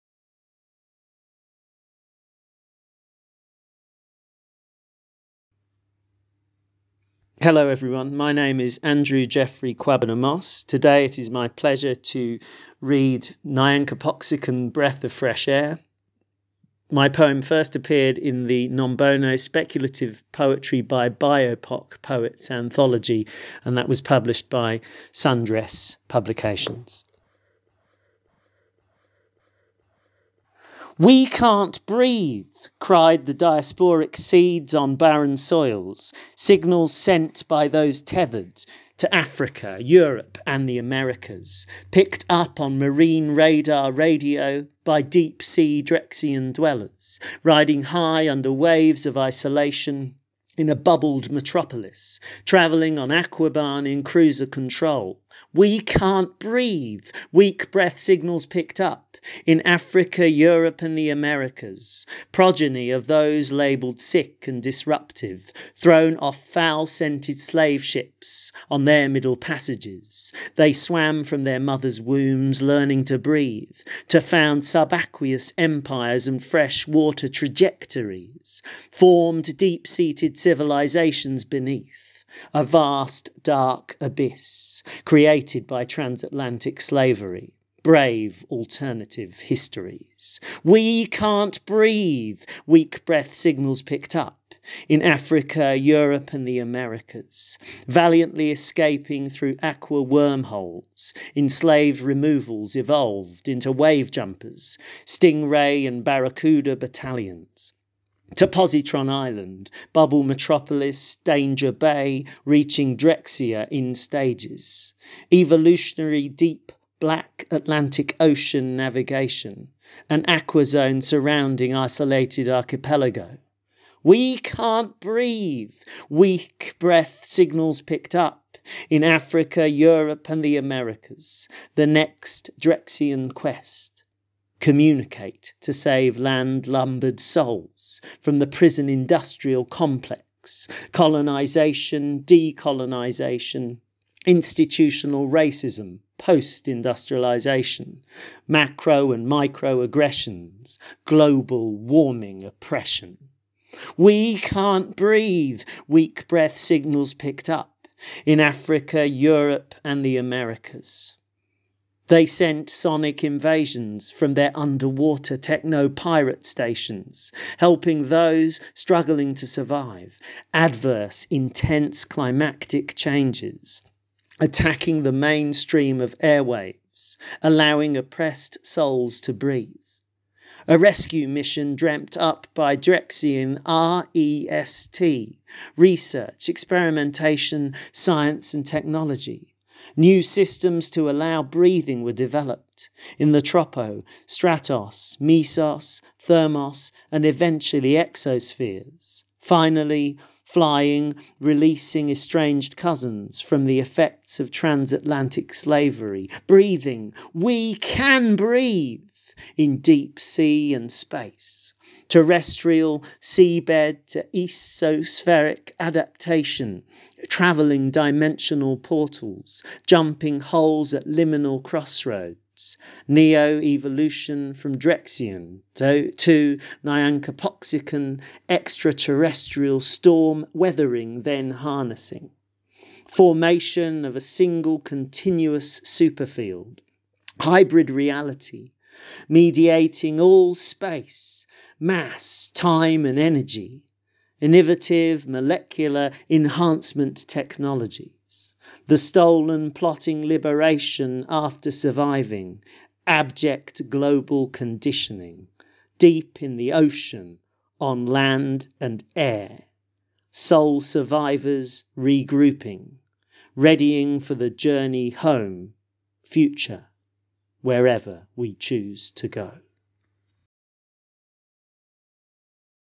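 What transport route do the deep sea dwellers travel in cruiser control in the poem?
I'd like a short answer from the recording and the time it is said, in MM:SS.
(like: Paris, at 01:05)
Aquabahn, at 00:53.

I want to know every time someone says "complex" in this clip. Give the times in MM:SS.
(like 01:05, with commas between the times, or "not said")
02:19.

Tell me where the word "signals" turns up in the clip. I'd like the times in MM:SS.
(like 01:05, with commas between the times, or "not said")
00:36, 00:57, 01:33, 02:07, 02:36.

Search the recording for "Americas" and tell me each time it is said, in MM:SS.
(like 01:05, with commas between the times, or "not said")
00:40, 01:01, 01:36, 02:10, 02:40.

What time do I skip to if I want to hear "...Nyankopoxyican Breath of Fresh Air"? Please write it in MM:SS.
00:13.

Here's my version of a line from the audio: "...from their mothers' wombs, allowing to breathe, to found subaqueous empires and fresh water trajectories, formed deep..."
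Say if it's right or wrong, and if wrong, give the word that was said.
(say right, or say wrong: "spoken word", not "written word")
wrong: "learning", not "allowing".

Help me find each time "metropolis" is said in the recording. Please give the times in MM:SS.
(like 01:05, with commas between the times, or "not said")
00:51, 01:50.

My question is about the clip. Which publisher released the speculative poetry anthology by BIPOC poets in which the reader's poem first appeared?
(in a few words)
Sundress Publications.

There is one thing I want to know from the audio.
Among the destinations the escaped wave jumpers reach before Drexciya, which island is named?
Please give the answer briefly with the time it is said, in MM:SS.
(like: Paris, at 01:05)
Positron Island, at 01:48.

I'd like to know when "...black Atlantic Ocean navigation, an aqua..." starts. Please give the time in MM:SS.
01:57.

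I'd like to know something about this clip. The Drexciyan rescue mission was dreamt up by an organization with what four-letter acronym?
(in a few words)
REST.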